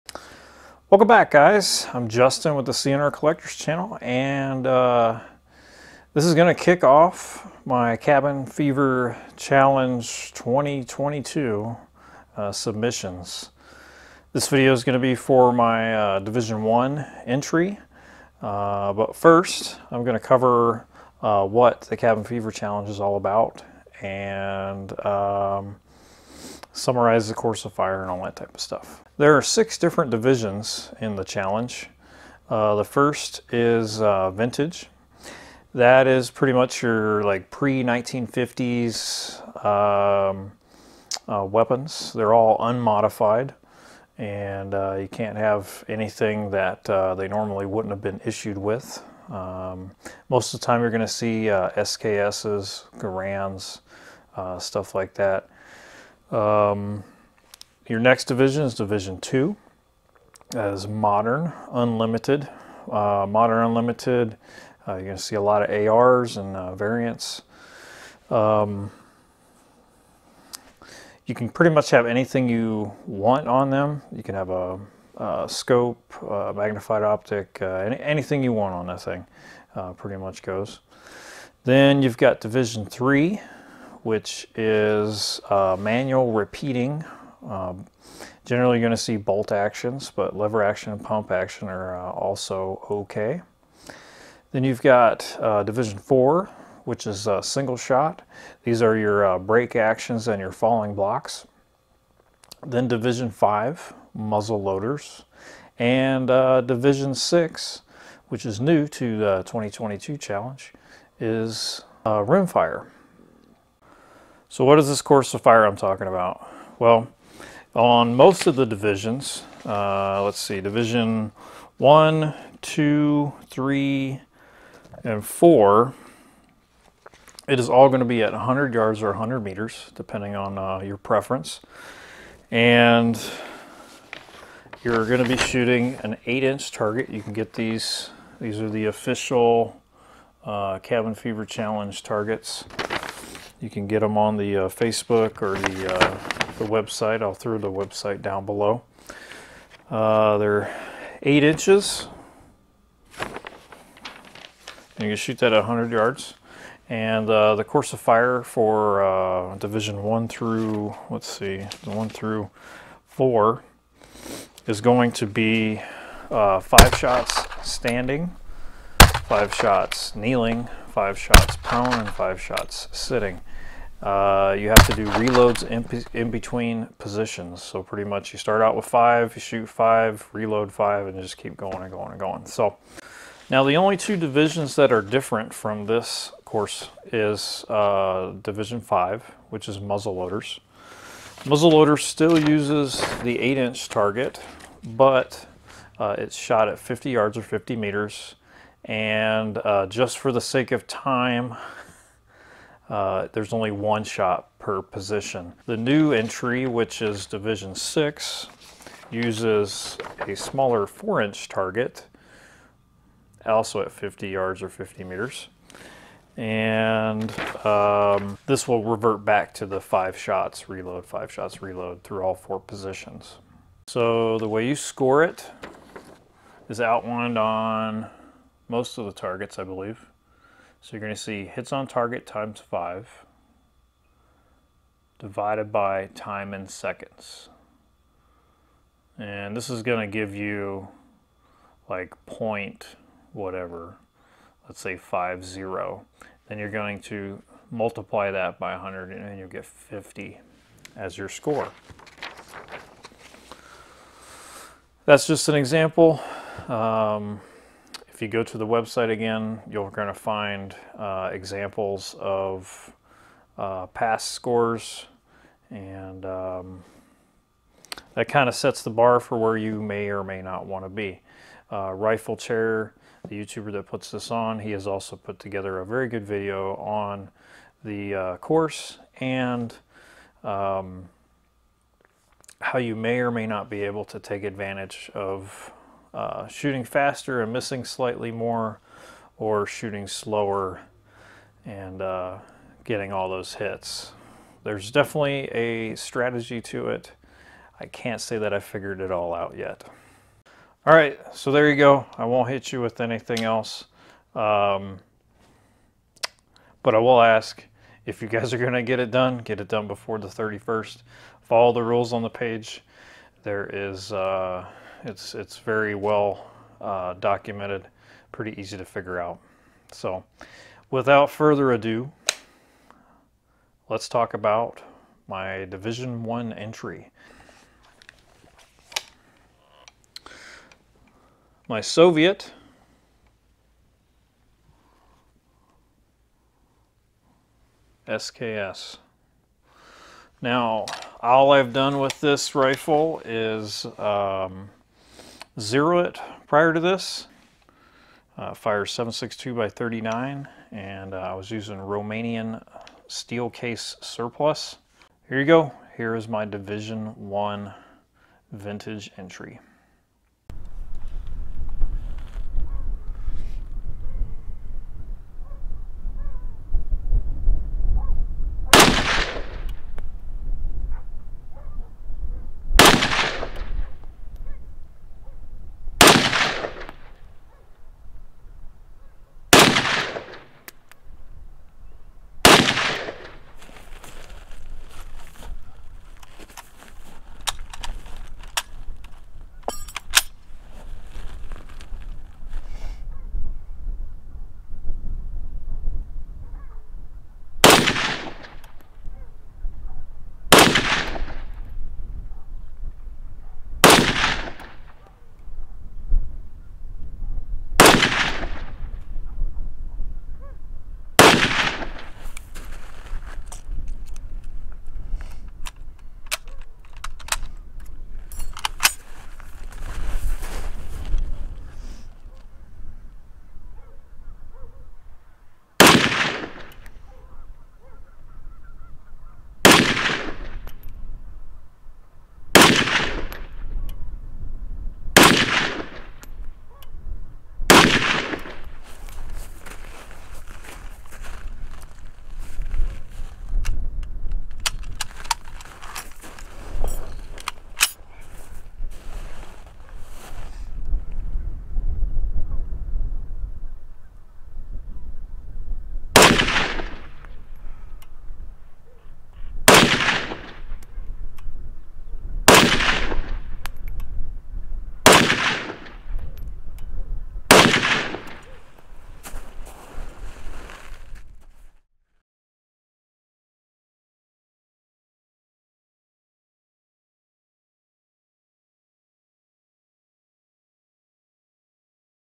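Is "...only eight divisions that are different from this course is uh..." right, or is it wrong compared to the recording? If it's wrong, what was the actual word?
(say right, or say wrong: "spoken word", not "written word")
wrong: "two", not "eight".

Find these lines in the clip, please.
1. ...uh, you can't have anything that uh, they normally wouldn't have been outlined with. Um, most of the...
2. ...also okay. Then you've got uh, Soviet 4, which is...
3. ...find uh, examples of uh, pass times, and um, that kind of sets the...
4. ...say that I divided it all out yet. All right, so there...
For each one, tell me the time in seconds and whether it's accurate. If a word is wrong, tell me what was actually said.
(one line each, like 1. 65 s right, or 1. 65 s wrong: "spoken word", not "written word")
1. 44 s wrong: "issued", not "outlined"
2. 92 s wrong: "Division", not "Soviet"
3. 260 s wrong: "scores", not "times"
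4. 298 s wrong: "figured", not "divided".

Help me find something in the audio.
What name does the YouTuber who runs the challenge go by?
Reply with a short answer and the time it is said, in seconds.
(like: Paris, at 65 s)
Riflechair, at 271 s.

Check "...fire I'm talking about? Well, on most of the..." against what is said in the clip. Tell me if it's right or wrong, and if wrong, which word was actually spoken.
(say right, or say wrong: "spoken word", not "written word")
right.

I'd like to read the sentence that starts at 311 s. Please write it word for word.
Follow the rules on the page.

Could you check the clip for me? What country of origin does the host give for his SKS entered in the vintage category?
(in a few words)
Soviet.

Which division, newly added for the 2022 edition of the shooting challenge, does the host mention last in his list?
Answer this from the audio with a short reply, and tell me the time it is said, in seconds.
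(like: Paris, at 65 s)
Rimfire, at 112 s.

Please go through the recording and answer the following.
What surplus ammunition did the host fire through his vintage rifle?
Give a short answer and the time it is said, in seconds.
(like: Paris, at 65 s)
Romanian steel case, at 351 s.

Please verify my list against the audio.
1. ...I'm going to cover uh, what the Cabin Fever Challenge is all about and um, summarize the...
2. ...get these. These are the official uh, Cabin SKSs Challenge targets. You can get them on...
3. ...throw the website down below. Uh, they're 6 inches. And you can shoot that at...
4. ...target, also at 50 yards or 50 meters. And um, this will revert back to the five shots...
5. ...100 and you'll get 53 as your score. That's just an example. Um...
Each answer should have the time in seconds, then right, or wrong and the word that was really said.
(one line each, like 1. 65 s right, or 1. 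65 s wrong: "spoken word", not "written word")
1. 19 s right
2. 137 s wrong: "Fever", not "SKSs"
3. 147 s wrong: "8", not "6"
4. 211 s right
5. 248 s wrong: "50", not "53".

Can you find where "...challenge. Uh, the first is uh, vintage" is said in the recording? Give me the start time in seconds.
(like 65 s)
31 s.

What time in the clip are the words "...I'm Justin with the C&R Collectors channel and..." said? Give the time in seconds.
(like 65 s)
1 s.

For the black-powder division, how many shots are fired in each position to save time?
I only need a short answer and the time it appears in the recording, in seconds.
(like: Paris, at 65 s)
1, at 203 s.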